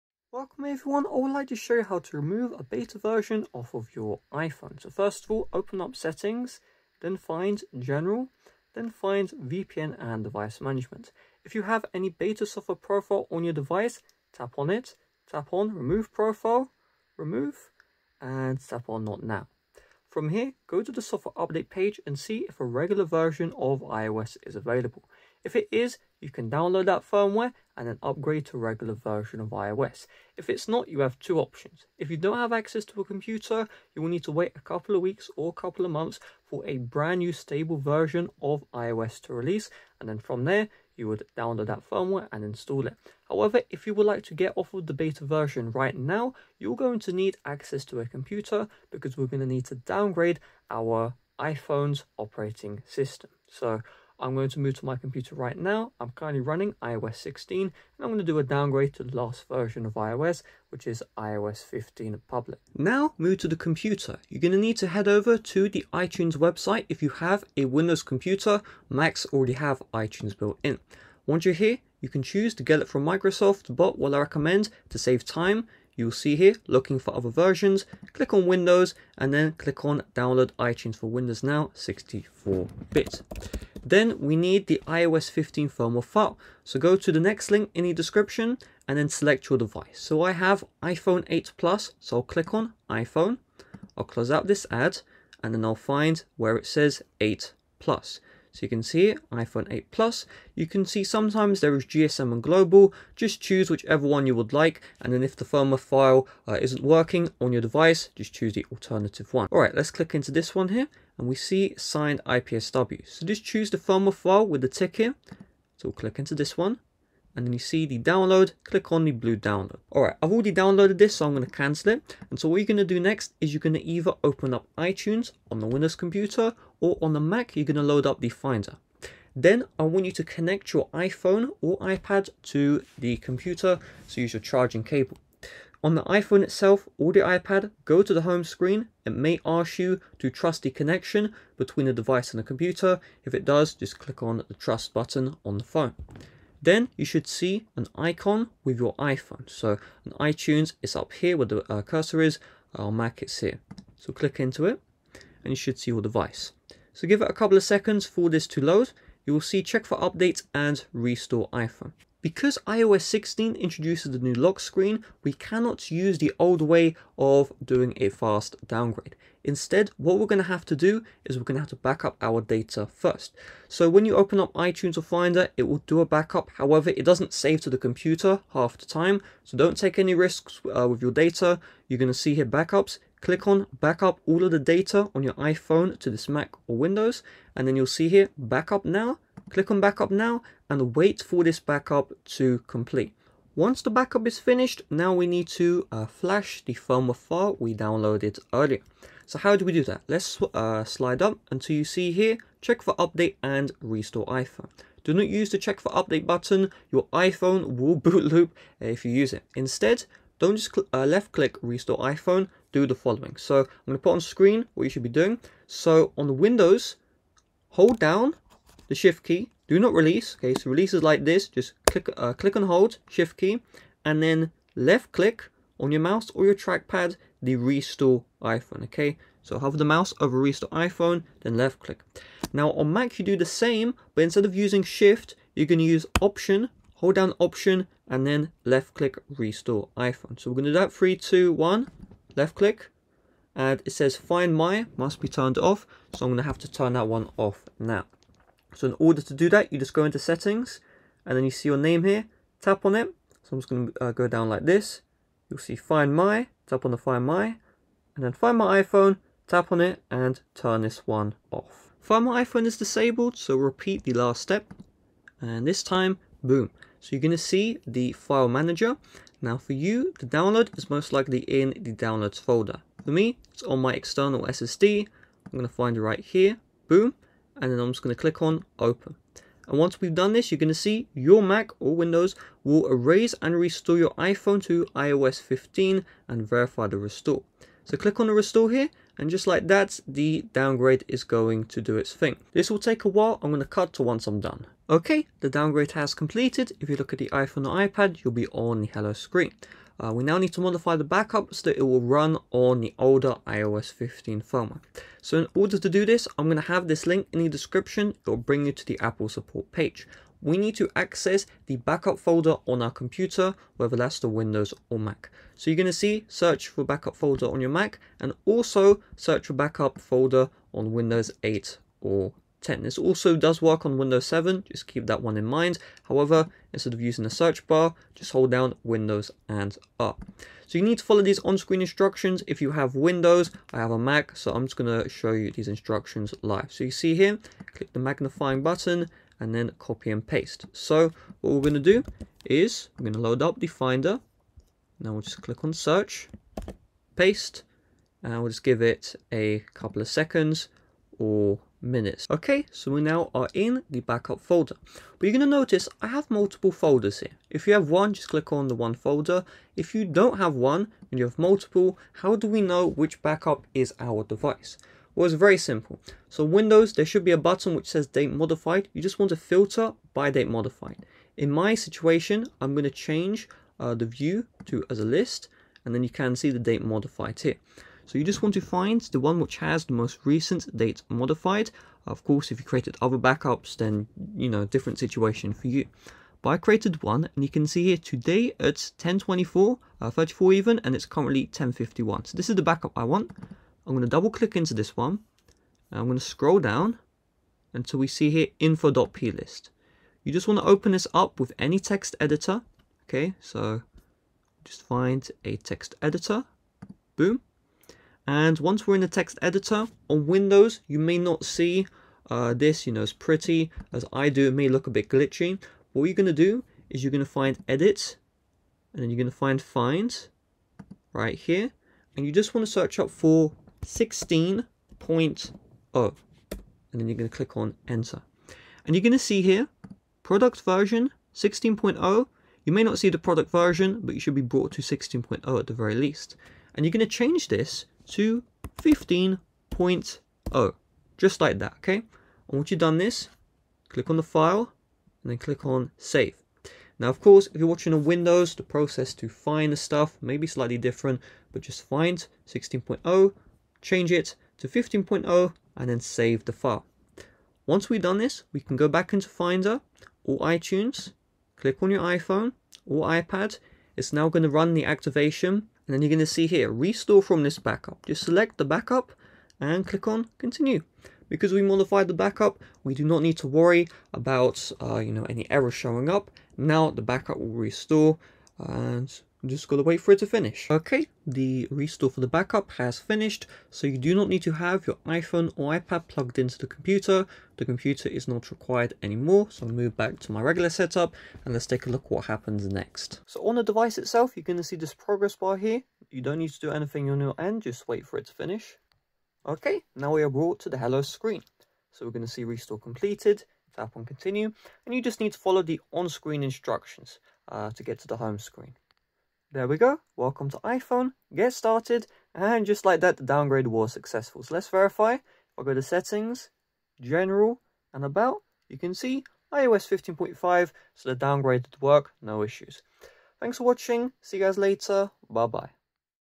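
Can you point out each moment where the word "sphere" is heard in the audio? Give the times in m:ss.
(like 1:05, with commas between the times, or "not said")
not said.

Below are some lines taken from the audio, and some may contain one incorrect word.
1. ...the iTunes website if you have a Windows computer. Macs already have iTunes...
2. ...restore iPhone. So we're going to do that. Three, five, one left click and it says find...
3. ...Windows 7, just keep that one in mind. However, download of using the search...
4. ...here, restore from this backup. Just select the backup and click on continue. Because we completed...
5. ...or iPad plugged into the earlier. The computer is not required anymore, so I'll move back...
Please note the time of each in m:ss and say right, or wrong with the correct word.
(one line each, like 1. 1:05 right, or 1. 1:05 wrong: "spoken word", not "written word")
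1. 1:05 right
2. 3:59 wrong: "two", not "five"
3. 5:23 wrong: "instead", not "download"
4. 7:46 wrong: "modified", not "completed"
5. 8:05 wrong: "computer", not "earlier".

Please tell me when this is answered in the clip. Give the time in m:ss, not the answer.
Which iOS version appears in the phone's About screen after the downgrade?
8:39.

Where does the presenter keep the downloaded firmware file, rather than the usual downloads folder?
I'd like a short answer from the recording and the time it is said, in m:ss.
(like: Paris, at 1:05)
external SSD, at 4:33.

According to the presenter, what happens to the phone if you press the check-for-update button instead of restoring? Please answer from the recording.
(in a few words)
boot loop.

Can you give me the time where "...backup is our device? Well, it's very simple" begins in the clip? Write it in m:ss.
6:03.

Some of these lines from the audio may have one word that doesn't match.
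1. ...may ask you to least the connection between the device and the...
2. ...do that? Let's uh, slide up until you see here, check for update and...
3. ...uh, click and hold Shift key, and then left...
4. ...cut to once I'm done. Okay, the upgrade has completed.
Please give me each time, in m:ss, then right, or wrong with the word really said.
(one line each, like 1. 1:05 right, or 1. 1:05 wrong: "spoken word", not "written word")
1. 2:19 wrong: "trust", not "least"
2. 3:19 right
3. 3:42 right
4. 4:53 wrong: "downgrade", not "upgrade".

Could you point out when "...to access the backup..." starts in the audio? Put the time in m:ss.
5:10.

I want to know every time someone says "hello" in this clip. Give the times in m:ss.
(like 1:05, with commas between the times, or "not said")
4:58, 8:20.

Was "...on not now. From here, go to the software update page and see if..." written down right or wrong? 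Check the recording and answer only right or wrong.
right.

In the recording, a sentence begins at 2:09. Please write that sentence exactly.
Then I want you to connect your iPhone or iPad to the computer, so use your charging cable.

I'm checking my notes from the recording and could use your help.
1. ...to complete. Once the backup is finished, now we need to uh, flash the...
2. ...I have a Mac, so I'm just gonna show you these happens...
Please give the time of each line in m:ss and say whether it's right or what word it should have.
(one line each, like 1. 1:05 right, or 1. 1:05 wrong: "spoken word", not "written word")
1. 3:12 right
2. 5:33 wrong: "instructions", not "happens".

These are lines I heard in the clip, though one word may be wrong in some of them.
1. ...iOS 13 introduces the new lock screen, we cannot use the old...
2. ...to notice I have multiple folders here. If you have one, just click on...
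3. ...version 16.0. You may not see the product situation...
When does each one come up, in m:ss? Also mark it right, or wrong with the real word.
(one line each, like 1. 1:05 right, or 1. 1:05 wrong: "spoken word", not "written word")
1. 2:42 wrong: "16", not "13"
2. 5:55 right
3. 7:10 wrong: "version", not "situation".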